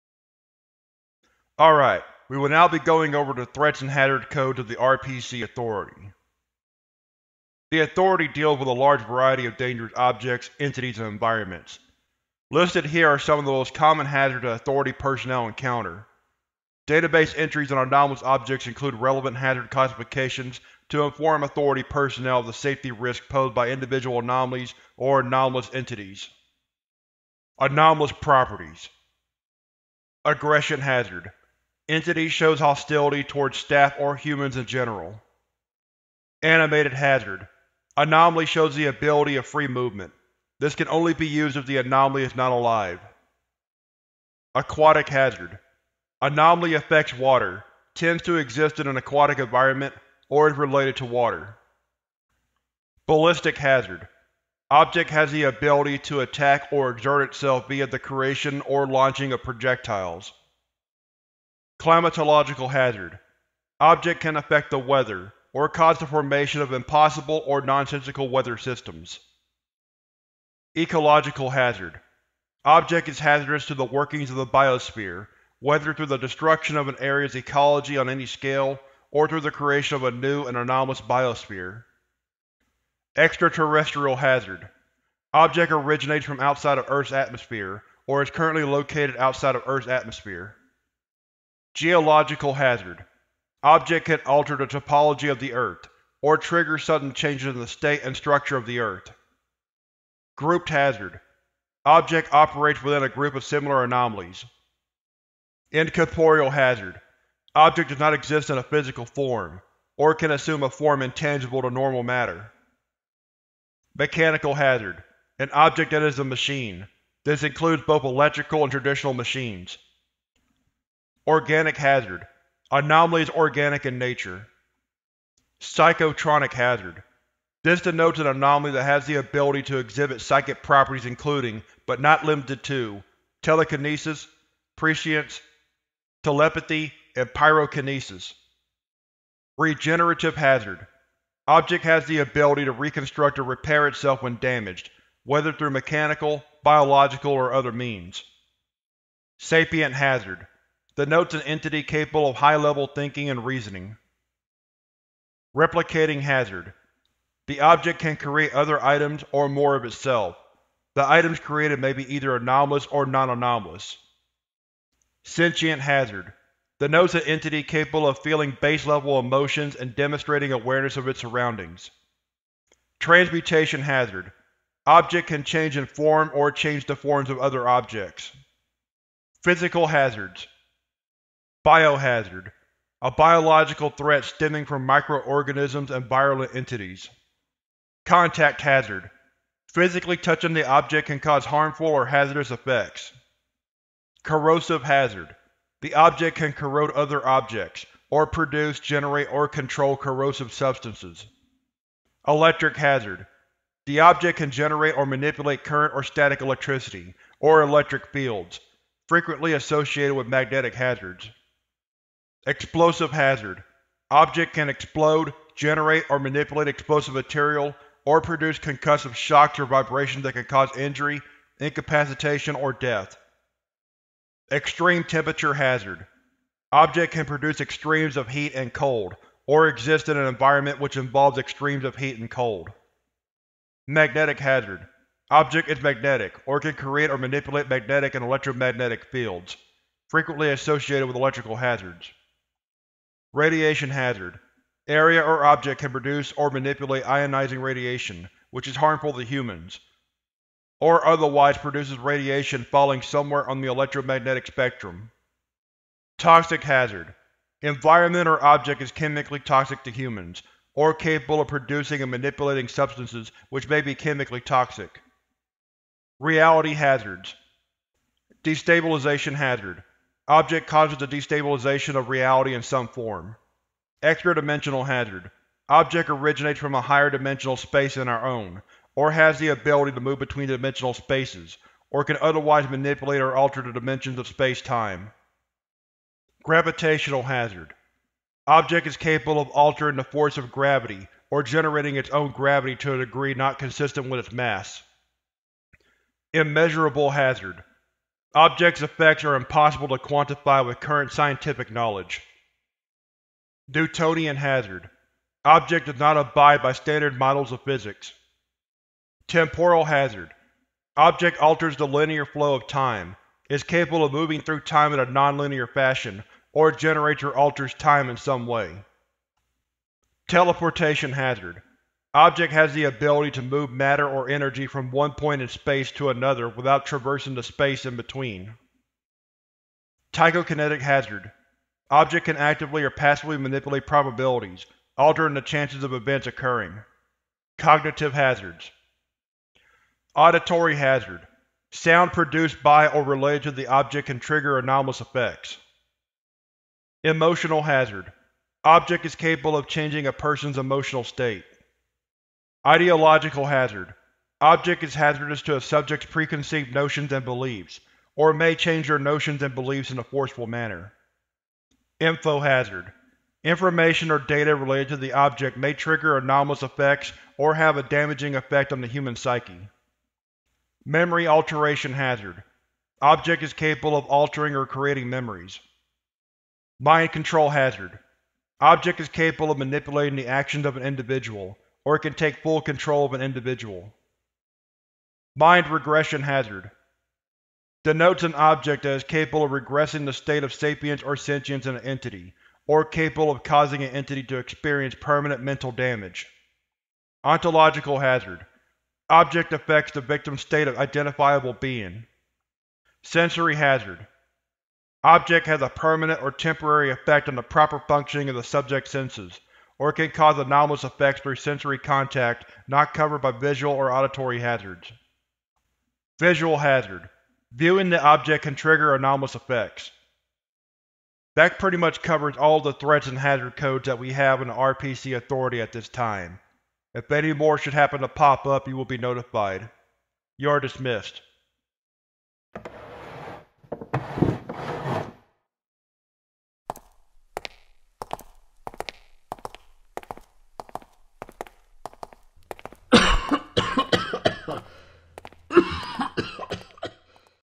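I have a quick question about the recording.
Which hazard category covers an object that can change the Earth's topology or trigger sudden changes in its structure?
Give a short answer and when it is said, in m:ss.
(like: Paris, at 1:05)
Geological hazard, at 1:31.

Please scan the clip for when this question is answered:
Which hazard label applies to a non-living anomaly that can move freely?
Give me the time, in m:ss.
0:36.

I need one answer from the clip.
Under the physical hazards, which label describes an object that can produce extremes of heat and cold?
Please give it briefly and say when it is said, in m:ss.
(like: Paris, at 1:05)
Extreme temperature hazard, at 3:44.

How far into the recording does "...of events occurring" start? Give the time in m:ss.
5:35.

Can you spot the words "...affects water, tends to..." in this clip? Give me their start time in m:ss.
0:46.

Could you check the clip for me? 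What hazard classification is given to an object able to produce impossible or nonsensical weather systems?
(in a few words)
Climatological hazard.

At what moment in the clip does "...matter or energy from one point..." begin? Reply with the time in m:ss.
5:23.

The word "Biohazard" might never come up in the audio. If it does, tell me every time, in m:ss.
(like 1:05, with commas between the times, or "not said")
3:01.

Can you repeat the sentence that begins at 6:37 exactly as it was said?
Ontological hazard Object affects the victim's state of identifiable being.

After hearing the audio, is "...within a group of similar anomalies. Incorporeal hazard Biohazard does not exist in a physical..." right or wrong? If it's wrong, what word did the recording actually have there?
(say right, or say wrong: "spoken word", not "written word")
wrong: "Object", not "Biohazard".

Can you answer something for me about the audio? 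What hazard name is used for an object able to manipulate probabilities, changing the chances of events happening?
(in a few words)
Tychokinetic hazard.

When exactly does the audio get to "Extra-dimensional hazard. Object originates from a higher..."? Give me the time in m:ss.
4:34.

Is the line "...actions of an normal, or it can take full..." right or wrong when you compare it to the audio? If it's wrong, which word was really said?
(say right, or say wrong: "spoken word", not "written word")
wrong: "individual", not "normal".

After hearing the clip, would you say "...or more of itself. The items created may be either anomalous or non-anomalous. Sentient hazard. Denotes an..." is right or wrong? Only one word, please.
right.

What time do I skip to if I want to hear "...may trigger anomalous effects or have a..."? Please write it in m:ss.
6:05.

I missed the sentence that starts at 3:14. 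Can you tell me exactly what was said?
Corrosive hazard the object can corrode other objects, or produce, generate, or control corrosive substances.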